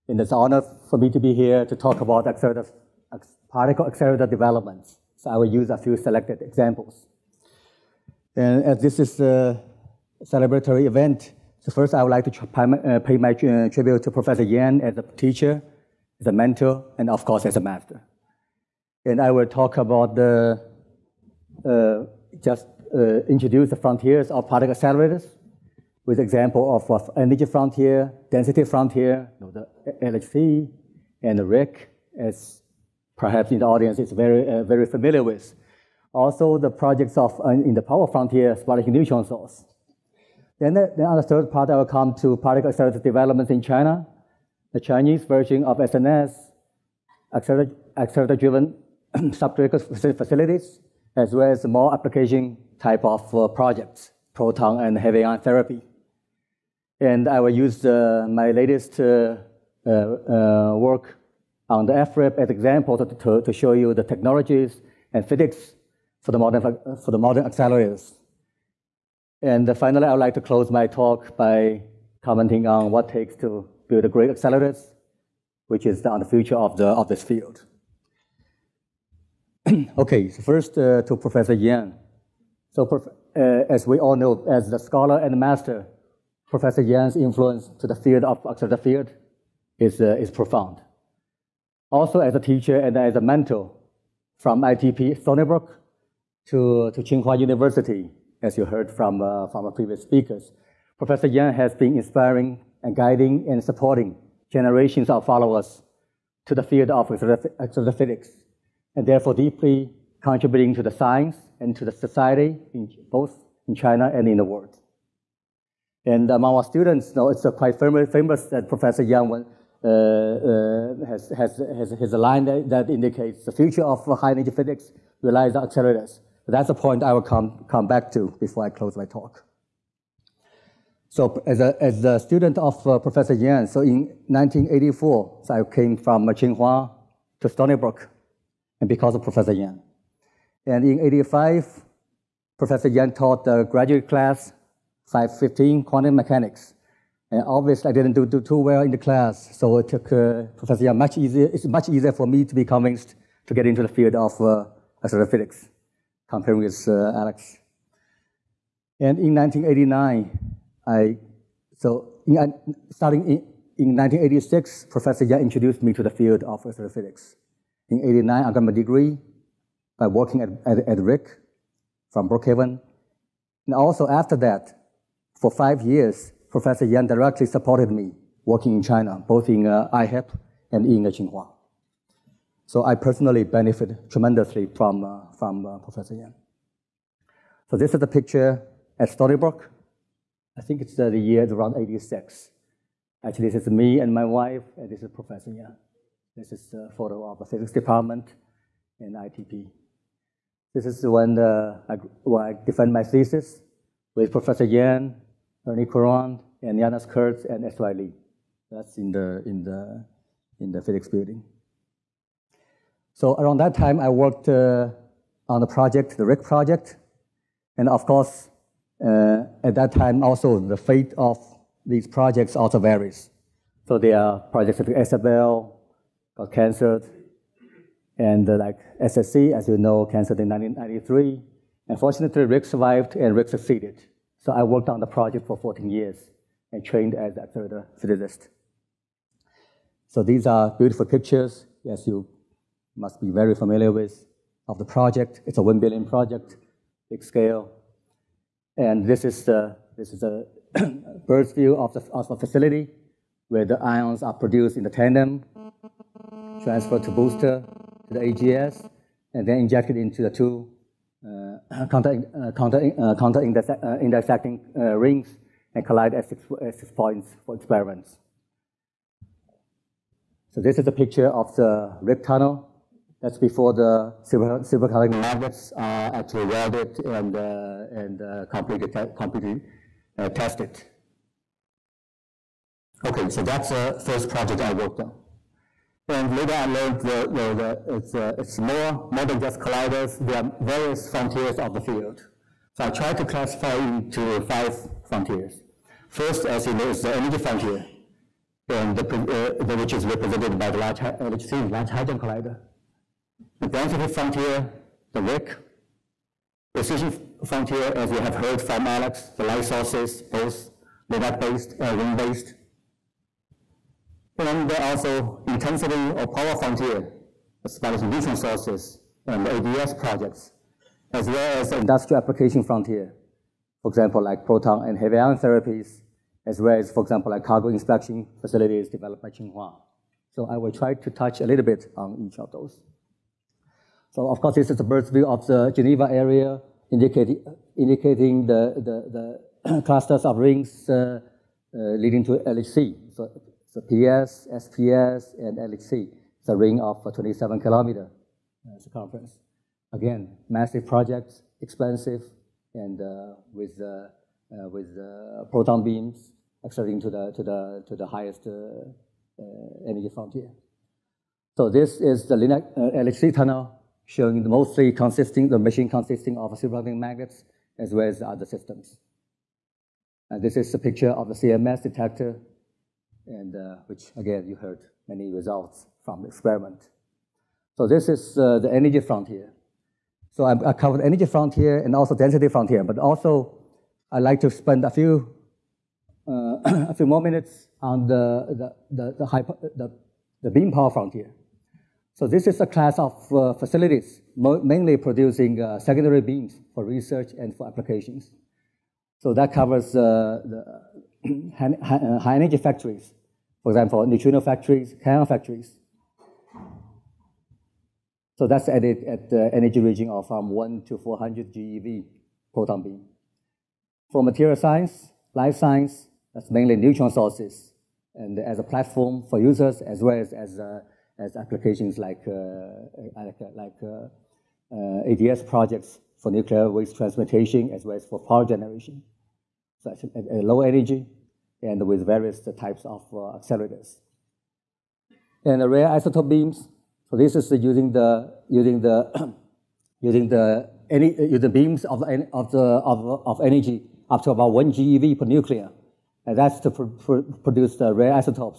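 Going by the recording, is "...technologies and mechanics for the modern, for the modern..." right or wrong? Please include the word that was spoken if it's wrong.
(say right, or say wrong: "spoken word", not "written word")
wrong: "physics", not "mechanics".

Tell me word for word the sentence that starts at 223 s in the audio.
So there are projects like SFL, got canceled, and uh, like SSC, as you know, canceled in 1993.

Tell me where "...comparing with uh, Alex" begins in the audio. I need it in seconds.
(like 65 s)
156 s.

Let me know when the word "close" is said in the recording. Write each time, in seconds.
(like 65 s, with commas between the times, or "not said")
70 s, 128 s.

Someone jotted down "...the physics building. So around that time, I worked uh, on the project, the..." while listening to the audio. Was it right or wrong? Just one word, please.
right.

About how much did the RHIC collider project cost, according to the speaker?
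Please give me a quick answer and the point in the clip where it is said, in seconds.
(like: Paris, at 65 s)
1 billion, at 245 s.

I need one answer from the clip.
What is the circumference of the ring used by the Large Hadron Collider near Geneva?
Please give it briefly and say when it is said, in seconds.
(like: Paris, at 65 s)
27 kilometers, at 347 s.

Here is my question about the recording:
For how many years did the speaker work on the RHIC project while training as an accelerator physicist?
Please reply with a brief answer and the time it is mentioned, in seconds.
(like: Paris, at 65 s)
14, at 235 s.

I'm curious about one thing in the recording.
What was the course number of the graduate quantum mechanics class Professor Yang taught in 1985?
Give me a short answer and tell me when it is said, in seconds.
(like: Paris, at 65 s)
515, at 145 s.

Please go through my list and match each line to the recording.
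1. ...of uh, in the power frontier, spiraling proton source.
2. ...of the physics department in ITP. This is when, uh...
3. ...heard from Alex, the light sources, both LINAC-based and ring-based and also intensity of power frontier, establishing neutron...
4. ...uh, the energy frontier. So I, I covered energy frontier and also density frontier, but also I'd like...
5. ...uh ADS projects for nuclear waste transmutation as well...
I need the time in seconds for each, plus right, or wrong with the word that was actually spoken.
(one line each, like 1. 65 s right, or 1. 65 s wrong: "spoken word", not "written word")
1. 37 s wrong: "neutron", not "proton"
2. 197 s right
3. 308 s right
4. 378 s right
5. 425 s right.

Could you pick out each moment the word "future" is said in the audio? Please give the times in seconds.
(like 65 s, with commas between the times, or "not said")
76 s, 123 s.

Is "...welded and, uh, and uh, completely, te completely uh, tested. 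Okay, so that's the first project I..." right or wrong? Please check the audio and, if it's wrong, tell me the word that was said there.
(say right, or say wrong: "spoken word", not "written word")
right.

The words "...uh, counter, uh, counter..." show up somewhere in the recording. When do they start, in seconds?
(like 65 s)
262 s.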